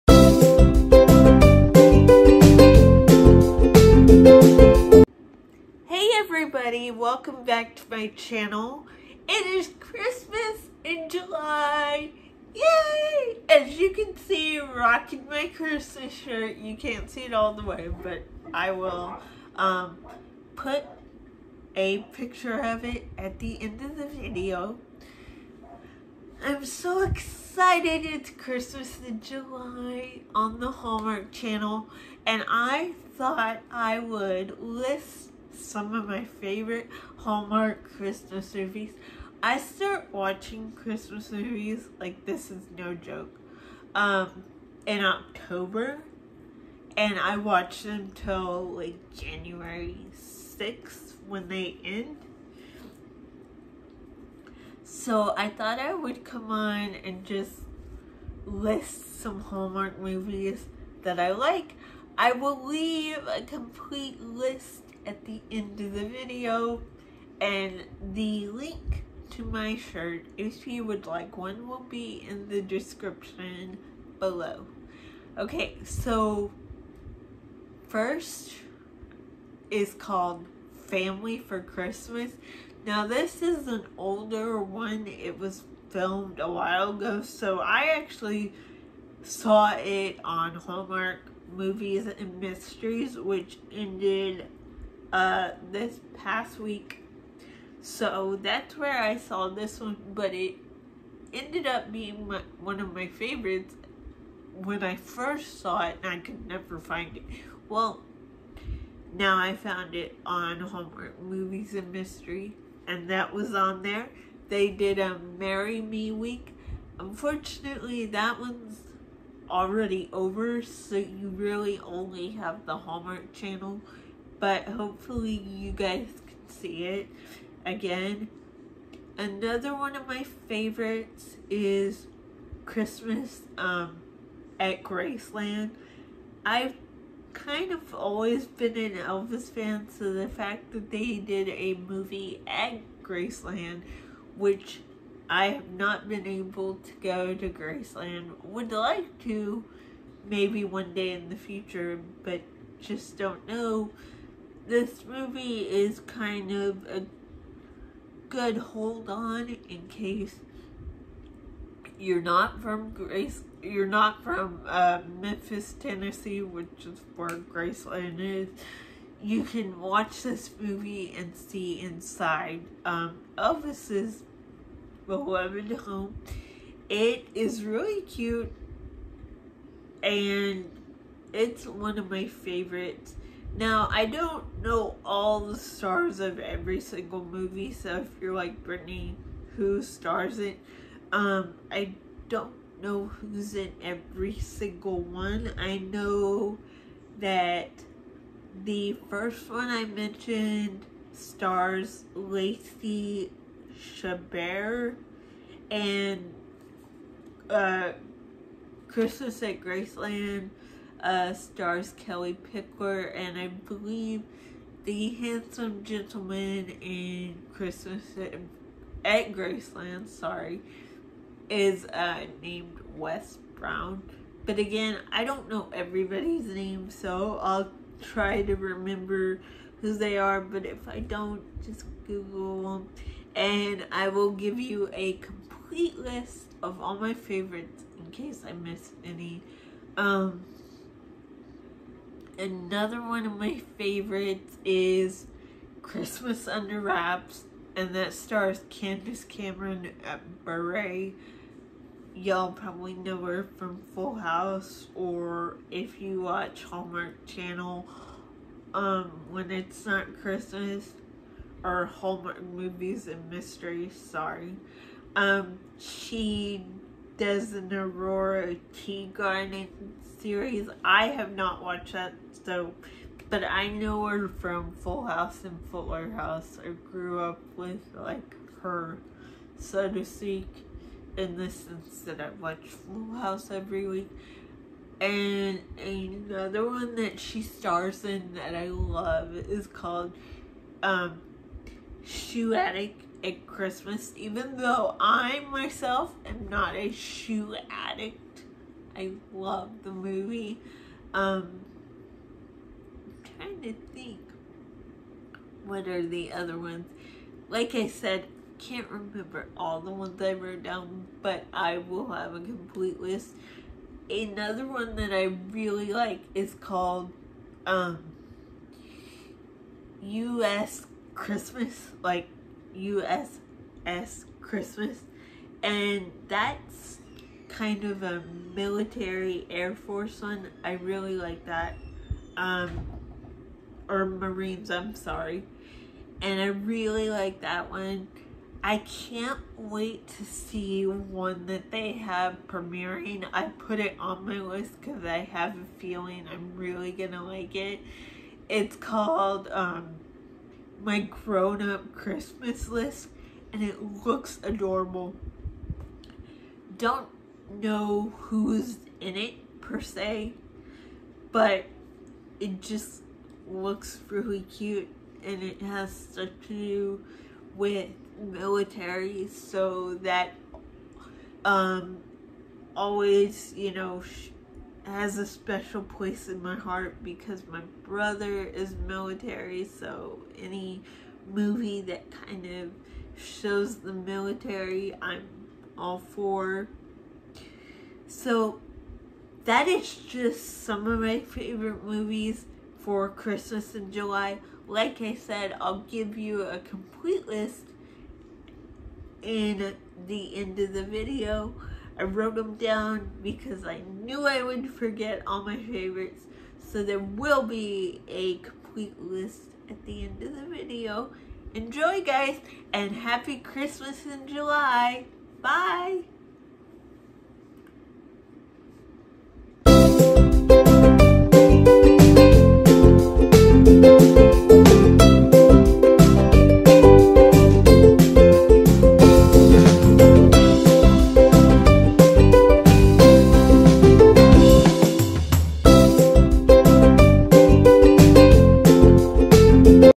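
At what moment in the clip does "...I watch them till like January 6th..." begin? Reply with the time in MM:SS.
00:47.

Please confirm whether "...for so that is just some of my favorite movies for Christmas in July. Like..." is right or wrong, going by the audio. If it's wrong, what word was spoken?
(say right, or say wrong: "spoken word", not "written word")
right.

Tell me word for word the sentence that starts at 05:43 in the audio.
I put it on my list because I have a feeling I'm really going to like it.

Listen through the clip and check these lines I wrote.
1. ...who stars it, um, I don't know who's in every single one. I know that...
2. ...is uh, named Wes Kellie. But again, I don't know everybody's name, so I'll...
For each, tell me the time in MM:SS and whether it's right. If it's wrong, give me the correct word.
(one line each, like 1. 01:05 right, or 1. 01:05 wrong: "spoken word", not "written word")
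1. 03:09 right
2. 03:41 wrong: "Brown", not "Kellie".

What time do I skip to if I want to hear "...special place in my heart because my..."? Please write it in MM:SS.
06:15.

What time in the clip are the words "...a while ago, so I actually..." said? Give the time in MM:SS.
01:26.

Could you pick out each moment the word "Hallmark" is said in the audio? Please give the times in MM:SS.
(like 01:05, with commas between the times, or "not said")
00:30, 00:37, 00:59, 01:30, 01:50, 02:02, 04:16, 04:21.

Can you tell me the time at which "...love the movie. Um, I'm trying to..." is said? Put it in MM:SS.
04:59.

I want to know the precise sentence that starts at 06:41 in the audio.
I wrote them down because I knew I would forget all my favorites.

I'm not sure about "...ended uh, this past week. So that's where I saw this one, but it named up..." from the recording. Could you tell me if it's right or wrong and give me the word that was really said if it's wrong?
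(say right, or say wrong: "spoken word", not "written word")
wrong: "ended", not "named".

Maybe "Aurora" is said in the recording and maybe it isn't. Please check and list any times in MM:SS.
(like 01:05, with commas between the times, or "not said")
04:27.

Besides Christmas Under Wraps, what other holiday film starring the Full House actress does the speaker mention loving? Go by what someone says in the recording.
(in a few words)
Shoe Addict at Christmas.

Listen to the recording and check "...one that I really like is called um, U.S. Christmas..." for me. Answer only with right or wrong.
right.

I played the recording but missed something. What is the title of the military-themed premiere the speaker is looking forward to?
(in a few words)
My Grown Up Christmas List.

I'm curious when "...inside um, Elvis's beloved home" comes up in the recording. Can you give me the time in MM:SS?
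02:51.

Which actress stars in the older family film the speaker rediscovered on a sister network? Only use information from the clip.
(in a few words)
Lacey Chabert.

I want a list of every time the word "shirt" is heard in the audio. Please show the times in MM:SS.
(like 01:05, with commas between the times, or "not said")
00:16, 01:09.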